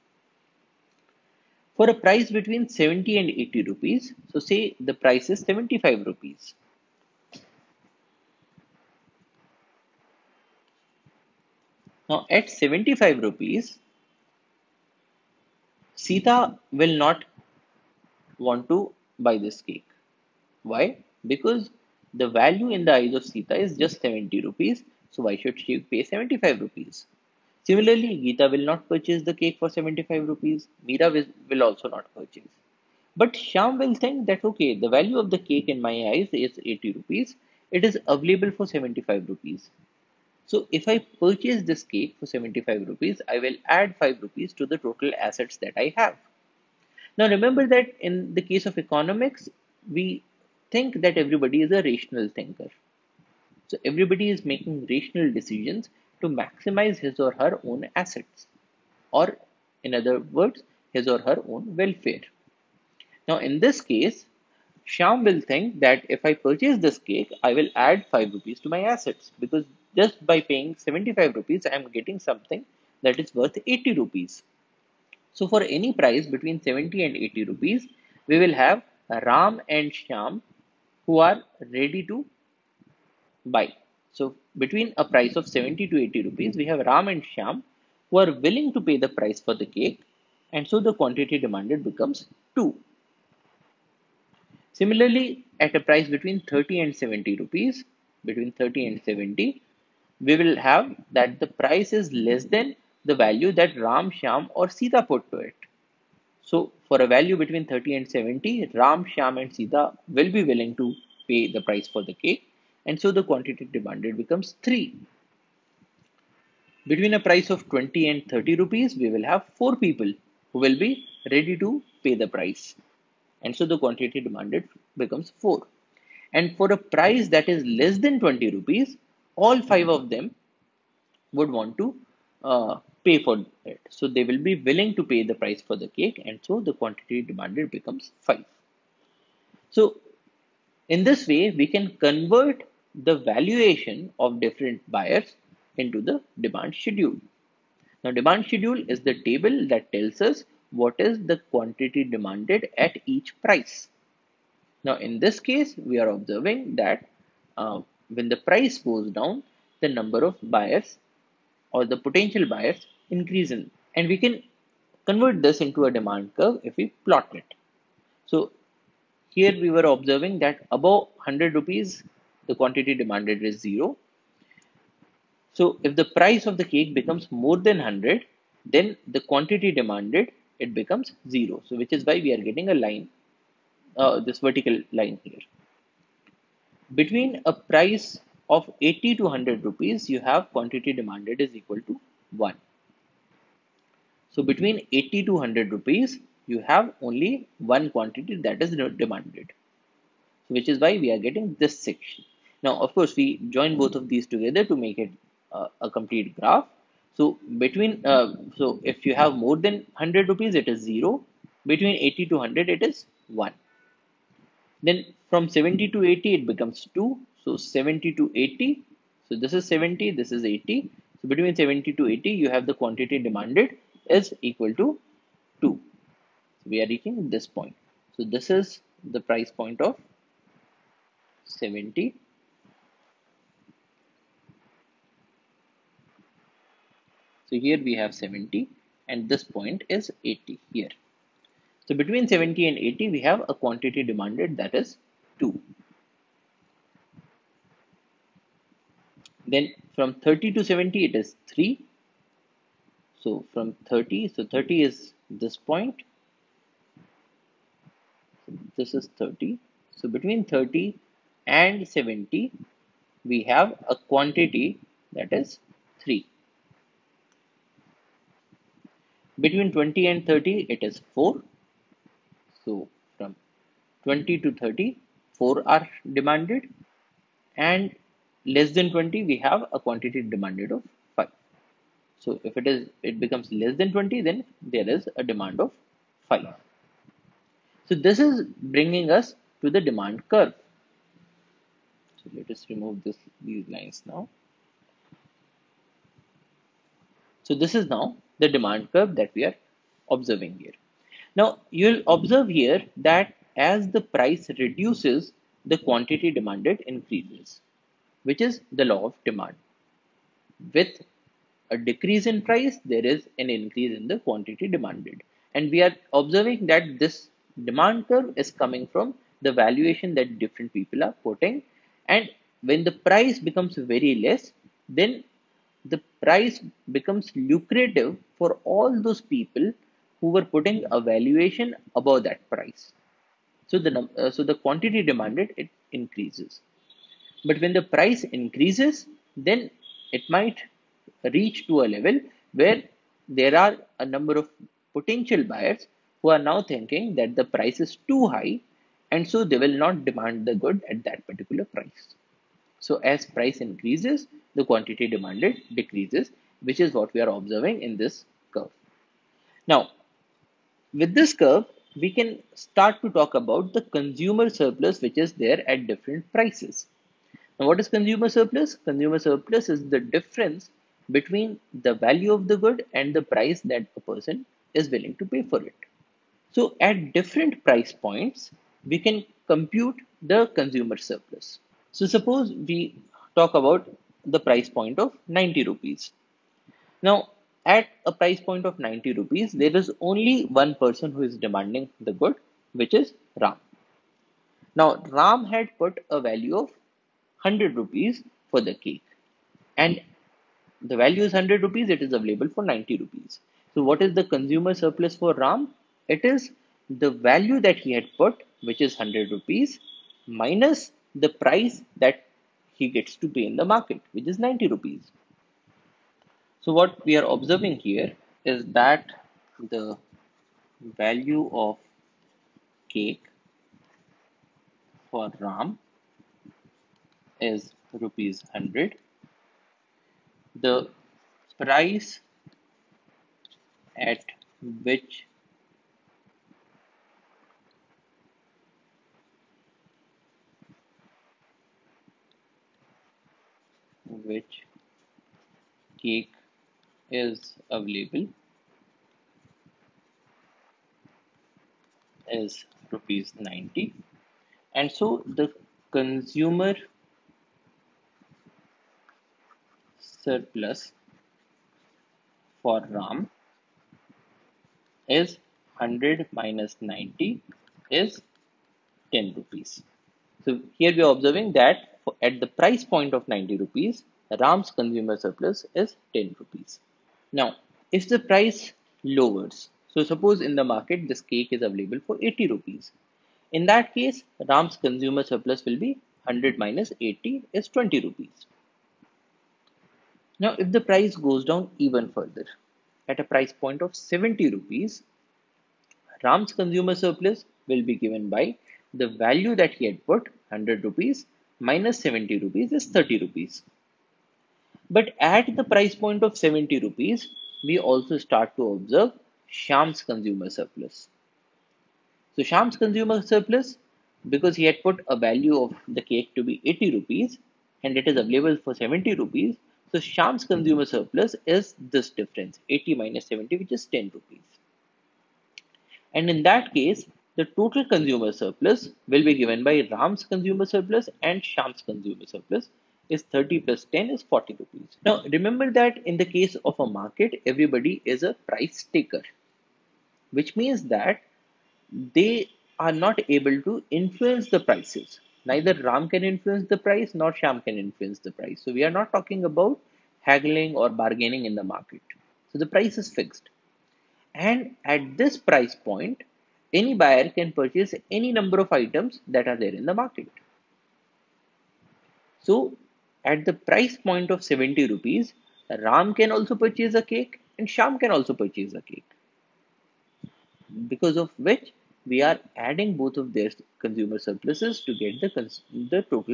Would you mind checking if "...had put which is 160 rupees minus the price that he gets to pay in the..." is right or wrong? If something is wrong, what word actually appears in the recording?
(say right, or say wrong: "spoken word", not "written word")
wrong: "100", not "160".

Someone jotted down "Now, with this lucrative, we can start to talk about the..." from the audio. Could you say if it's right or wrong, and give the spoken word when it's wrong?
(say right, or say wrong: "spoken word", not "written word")
wrong: "curve", not "lucrative".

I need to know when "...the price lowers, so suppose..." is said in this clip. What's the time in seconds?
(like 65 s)
478 s.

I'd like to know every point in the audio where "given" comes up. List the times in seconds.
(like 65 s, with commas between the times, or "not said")
497 s, 529 s.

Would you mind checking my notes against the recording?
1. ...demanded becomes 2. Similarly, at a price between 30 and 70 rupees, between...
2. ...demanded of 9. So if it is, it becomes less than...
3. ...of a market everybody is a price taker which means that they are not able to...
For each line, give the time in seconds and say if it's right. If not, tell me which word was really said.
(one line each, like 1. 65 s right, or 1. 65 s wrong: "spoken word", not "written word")
1. 91 s right
2. 280 s wrong: "5", not "9"
3. 536 s right.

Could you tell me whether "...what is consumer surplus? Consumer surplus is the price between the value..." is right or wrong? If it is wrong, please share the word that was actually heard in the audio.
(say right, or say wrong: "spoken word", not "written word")
wrong: "difference", not "price".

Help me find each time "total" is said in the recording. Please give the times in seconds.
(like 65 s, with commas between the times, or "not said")
44 s, 527 s.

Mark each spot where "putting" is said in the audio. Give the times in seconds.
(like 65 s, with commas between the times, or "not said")
321 s, 330 s.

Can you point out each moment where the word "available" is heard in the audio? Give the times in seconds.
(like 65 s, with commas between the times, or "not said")
38 s, 402 s, 447 s, 481 s, 518 s.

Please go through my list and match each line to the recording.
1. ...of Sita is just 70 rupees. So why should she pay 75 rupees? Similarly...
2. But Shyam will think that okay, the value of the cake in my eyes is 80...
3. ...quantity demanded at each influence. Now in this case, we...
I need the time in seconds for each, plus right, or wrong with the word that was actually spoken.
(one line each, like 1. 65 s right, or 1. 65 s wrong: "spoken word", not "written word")
1. 23 s right
2. 33 s right
3. 151 s wrong: "price", not "influence".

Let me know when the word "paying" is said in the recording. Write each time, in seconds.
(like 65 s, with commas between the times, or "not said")
70 s.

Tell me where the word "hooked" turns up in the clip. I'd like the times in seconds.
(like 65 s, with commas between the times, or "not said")
not said.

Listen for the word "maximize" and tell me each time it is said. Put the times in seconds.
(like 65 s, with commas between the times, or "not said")
56 s.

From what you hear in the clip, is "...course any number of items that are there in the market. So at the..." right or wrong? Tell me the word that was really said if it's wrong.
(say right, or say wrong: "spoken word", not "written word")
wrong: "purchase", not "course".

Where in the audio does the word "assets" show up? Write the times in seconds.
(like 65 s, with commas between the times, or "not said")
45 s, 57 s, 68 s.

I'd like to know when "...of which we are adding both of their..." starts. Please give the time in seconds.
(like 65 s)
571 s.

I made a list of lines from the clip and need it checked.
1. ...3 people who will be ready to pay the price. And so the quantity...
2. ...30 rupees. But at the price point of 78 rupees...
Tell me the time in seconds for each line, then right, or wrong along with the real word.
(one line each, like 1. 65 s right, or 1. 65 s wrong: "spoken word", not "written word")
1. 119 s wrong: "4", not "3"
2. 502 s wrong: "70", not "78".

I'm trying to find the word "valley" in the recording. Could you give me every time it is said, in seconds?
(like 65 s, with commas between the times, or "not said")
not said.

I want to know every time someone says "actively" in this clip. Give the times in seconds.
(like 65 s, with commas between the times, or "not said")
not said.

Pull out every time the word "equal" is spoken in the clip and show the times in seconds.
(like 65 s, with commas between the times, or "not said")
191 s, 224 s.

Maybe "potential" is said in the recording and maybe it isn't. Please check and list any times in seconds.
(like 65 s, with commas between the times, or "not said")
162 s, 344 s.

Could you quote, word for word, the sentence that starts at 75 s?
So, for any price between 70 and 80 rupees, we will have Ram and Shyam who are ready to buy.